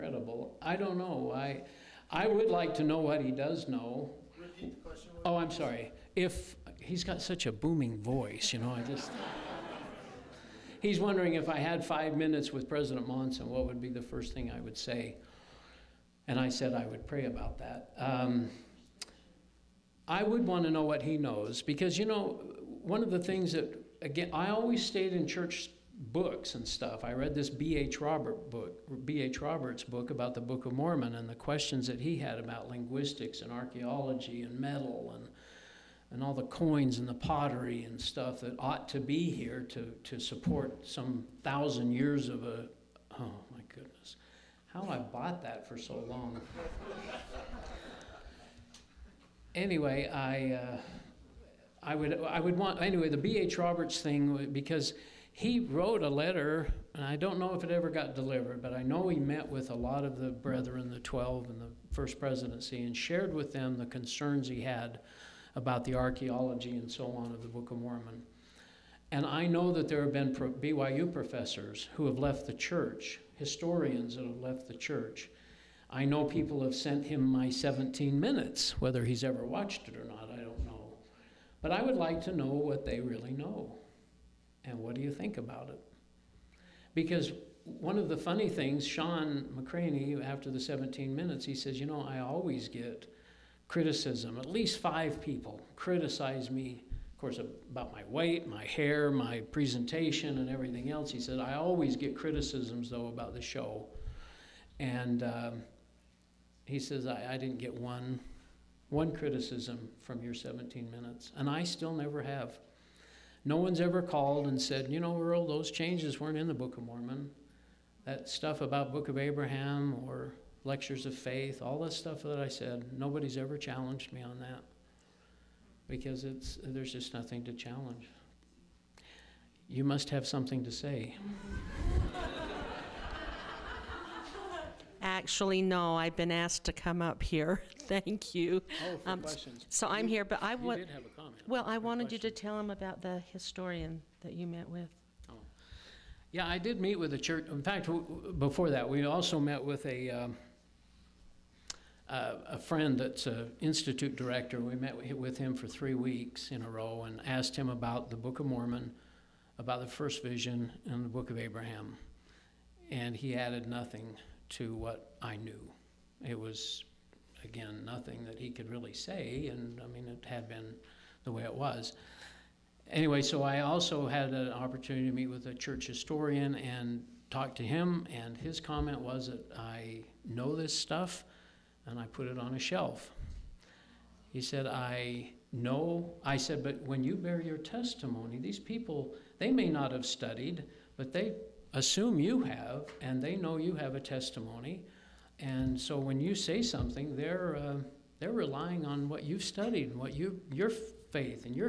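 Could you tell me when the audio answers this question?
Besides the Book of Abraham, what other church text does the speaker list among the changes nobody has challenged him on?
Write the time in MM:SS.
02:00.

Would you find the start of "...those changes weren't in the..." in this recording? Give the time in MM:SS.
01:55.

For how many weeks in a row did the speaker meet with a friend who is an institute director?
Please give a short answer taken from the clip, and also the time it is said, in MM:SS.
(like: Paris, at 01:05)
3, at 02:35.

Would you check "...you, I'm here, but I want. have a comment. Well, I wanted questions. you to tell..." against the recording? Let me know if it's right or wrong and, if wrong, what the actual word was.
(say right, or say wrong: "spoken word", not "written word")
right.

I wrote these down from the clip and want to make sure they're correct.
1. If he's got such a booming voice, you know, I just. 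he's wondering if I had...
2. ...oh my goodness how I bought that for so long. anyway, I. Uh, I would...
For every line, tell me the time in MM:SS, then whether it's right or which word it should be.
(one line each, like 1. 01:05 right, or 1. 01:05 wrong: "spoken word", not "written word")
1. 00:06 right
2. 00:43 right.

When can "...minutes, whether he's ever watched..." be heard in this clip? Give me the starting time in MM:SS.
01:18.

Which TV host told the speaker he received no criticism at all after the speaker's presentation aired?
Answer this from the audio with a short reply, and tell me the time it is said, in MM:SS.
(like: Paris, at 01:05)
Shawn McCraney, at 01:28.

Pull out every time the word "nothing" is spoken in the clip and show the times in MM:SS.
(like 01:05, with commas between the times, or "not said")
02:07, 02:43, 02:47.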